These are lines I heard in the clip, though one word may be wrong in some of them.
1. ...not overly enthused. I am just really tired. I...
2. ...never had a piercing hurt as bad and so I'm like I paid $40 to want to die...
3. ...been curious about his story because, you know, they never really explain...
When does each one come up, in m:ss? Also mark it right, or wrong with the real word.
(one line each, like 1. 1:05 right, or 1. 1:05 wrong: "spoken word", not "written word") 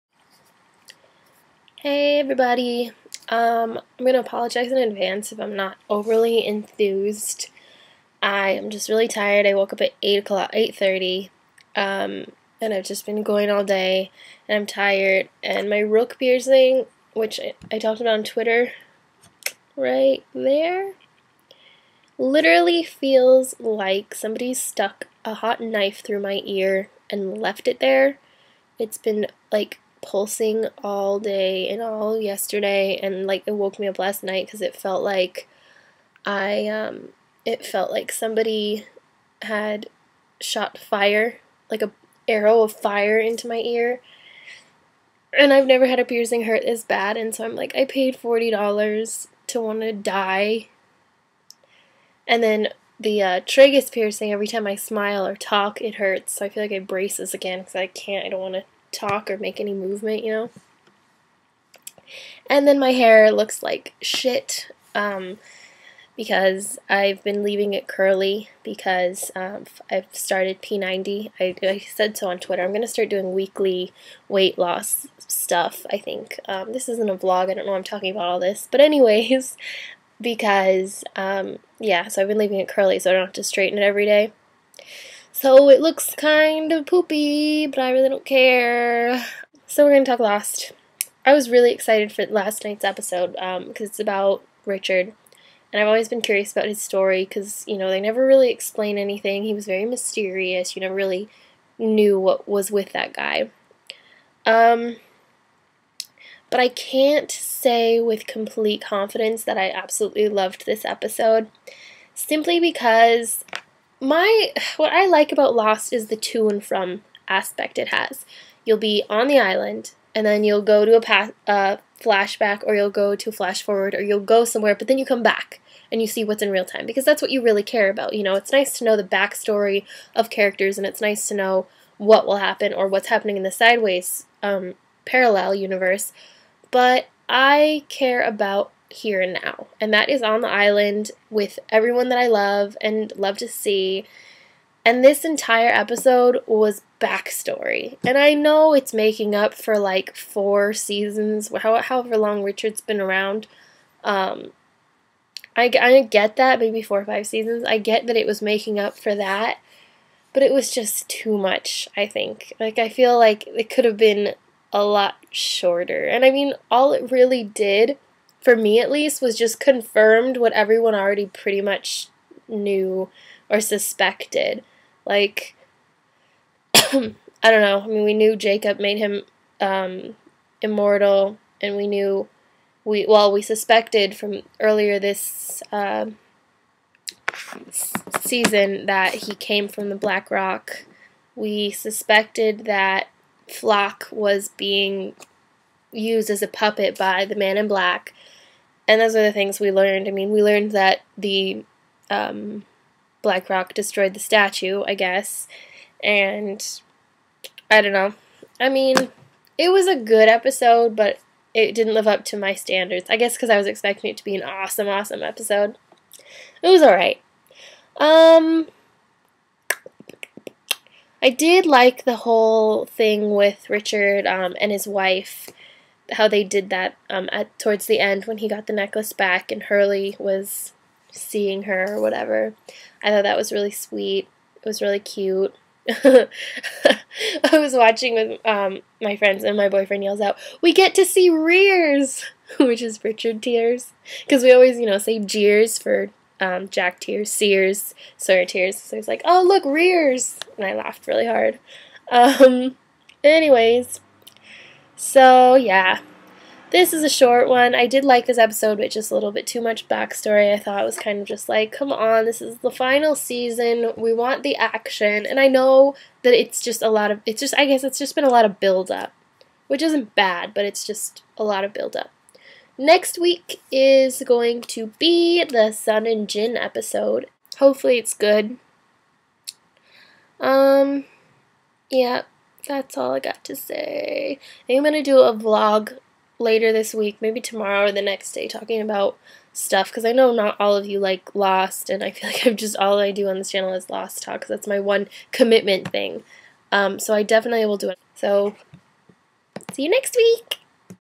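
1. 0:05 right
2. 0:45 right
3. 1:36 right.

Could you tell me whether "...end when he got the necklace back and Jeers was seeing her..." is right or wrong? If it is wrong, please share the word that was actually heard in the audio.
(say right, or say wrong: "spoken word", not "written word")
wrong: "Hurley", not "Jeers".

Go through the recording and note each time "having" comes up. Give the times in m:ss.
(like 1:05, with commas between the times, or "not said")
not said.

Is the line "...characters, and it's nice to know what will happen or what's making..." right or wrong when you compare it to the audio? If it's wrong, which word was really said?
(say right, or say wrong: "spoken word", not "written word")
wrong: "happening", not "making".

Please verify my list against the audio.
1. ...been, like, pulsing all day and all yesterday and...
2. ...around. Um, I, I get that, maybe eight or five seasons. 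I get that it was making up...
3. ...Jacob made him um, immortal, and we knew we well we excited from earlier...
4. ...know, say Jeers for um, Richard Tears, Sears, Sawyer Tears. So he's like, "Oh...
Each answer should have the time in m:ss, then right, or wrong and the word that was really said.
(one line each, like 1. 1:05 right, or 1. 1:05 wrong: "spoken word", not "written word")
1. 0:28 right
2. 2:33 wrong: "four", not "eight"
3. 2:58 wrong: "suspected", not "excited"
4. 4:04 wrong: "Jack", not "Richard".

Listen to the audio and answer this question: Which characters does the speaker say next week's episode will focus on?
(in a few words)
Sun and Jin.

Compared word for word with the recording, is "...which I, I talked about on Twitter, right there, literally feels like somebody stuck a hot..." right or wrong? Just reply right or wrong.
right.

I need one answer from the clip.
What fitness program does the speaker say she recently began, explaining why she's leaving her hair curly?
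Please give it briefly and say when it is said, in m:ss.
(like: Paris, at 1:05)
P90, at 1:10.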